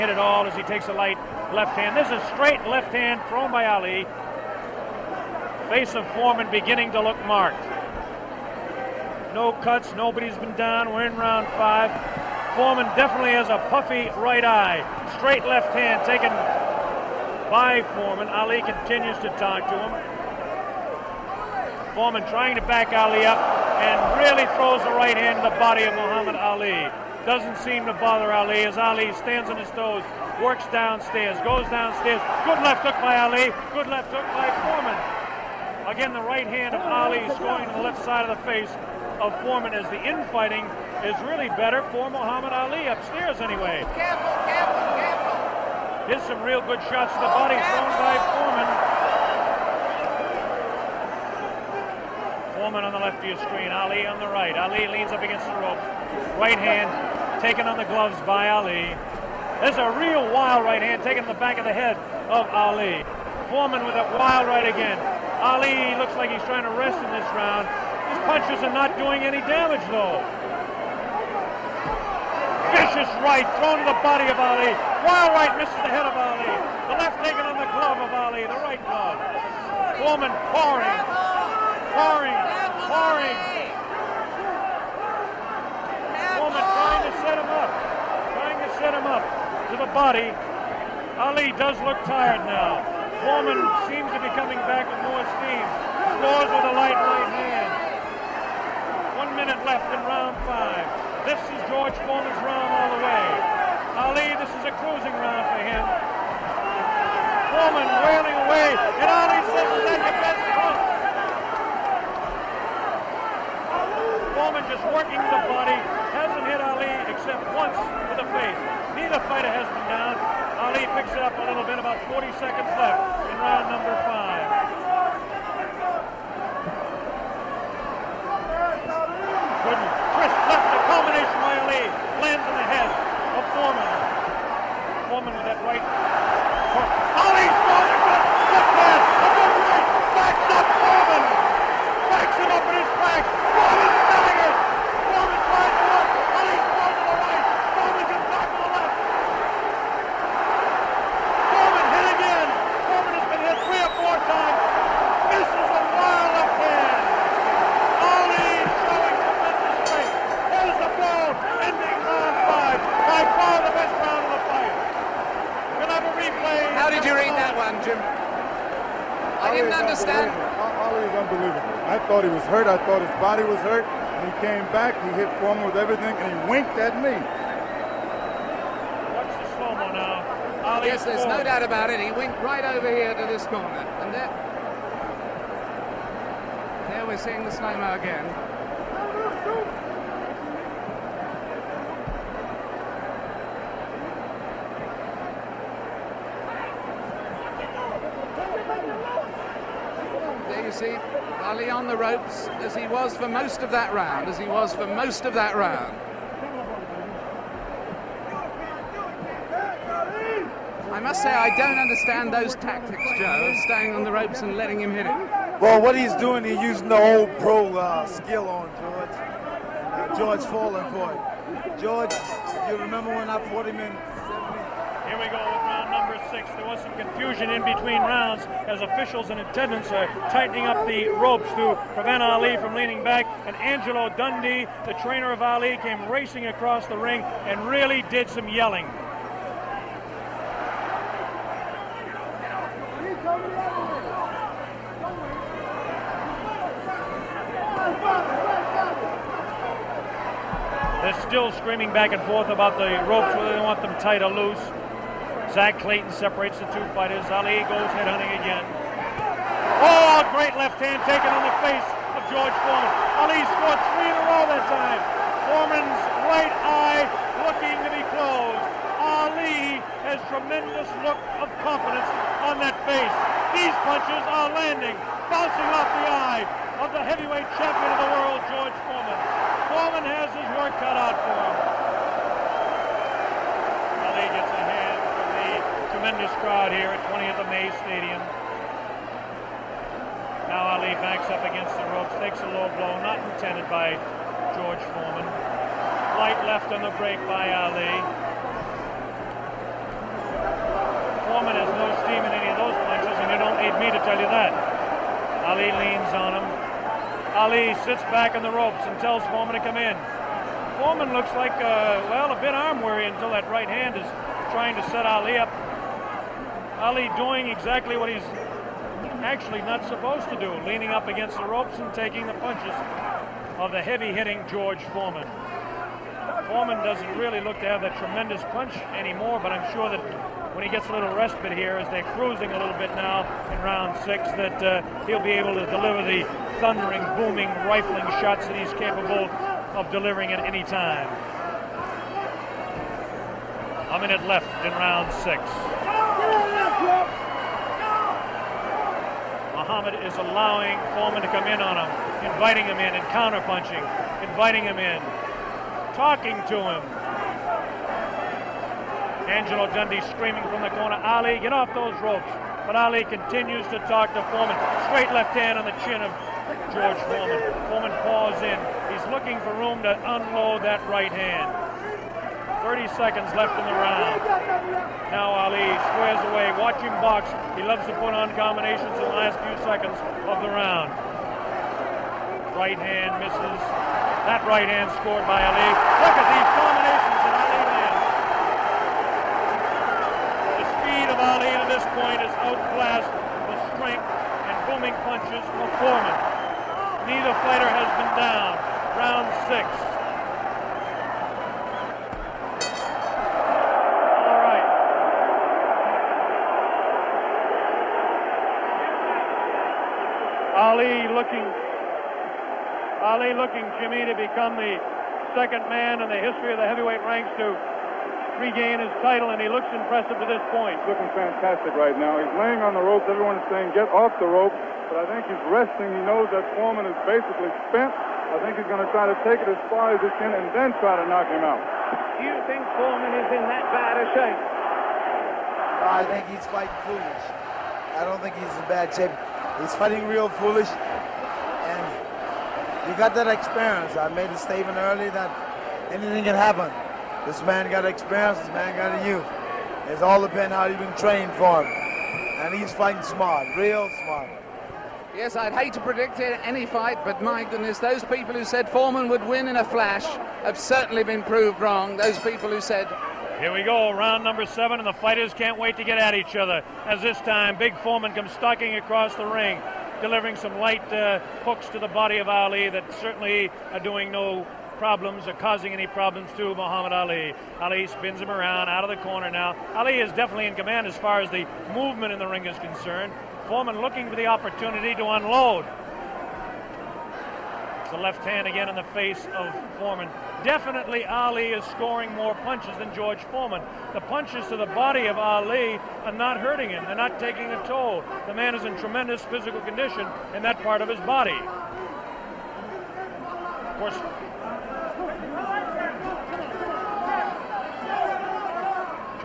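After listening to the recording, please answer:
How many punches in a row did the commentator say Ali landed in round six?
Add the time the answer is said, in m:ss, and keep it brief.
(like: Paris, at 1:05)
3, at 4:23.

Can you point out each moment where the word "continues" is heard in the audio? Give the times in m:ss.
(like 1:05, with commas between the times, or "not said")
0:18, 6:03.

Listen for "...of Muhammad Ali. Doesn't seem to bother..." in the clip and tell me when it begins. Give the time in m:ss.
0:25.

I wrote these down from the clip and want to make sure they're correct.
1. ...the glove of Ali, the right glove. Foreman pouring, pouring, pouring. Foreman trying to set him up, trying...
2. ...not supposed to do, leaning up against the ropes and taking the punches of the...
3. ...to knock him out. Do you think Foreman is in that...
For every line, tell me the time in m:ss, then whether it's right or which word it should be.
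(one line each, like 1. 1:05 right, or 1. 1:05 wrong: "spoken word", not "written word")
1. 1:17 right
2. 5:19 right
3. 7:11 right.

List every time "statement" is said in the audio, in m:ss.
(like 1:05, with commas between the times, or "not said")
7:24.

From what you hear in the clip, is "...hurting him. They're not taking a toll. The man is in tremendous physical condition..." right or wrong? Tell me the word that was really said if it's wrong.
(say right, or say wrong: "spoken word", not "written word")
right.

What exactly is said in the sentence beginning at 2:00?
Ali picks it up a little bit, about 40 seconds left in round number five.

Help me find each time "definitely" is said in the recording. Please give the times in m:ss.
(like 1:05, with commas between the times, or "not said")
0:12, 8:00, 8:10.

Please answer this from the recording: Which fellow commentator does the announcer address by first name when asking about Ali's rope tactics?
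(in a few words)
Joe.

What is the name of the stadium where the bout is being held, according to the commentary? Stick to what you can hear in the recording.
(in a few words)
20th of May Stadium.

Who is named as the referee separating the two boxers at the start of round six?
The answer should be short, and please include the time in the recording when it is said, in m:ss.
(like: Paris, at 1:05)
Zach Clayton, at 4:15.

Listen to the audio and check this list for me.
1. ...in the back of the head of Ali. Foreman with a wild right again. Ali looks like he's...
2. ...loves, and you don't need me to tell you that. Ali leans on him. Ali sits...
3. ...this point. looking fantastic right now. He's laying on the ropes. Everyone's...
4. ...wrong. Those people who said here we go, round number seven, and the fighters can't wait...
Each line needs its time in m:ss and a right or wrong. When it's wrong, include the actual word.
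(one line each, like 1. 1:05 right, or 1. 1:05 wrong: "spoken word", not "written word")
1. 1:01 right
2. 5:02 wrong: "punches", not "loves"
3. 7:00 right
4. 7:41 right.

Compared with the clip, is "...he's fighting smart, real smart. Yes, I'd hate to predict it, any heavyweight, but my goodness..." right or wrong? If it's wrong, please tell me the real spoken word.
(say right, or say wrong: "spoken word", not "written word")
wrong: "fight", not "heavyweight".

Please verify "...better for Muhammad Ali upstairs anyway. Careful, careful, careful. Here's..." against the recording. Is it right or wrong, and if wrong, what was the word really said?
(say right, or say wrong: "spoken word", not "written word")
right.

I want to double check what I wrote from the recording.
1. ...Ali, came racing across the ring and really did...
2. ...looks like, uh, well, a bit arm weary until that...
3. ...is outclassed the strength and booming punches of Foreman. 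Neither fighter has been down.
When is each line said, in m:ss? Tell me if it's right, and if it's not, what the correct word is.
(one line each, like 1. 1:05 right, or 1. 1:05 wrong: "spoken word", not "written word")
1. 3:55 right
2. 5:11 right
3. 6:32 right.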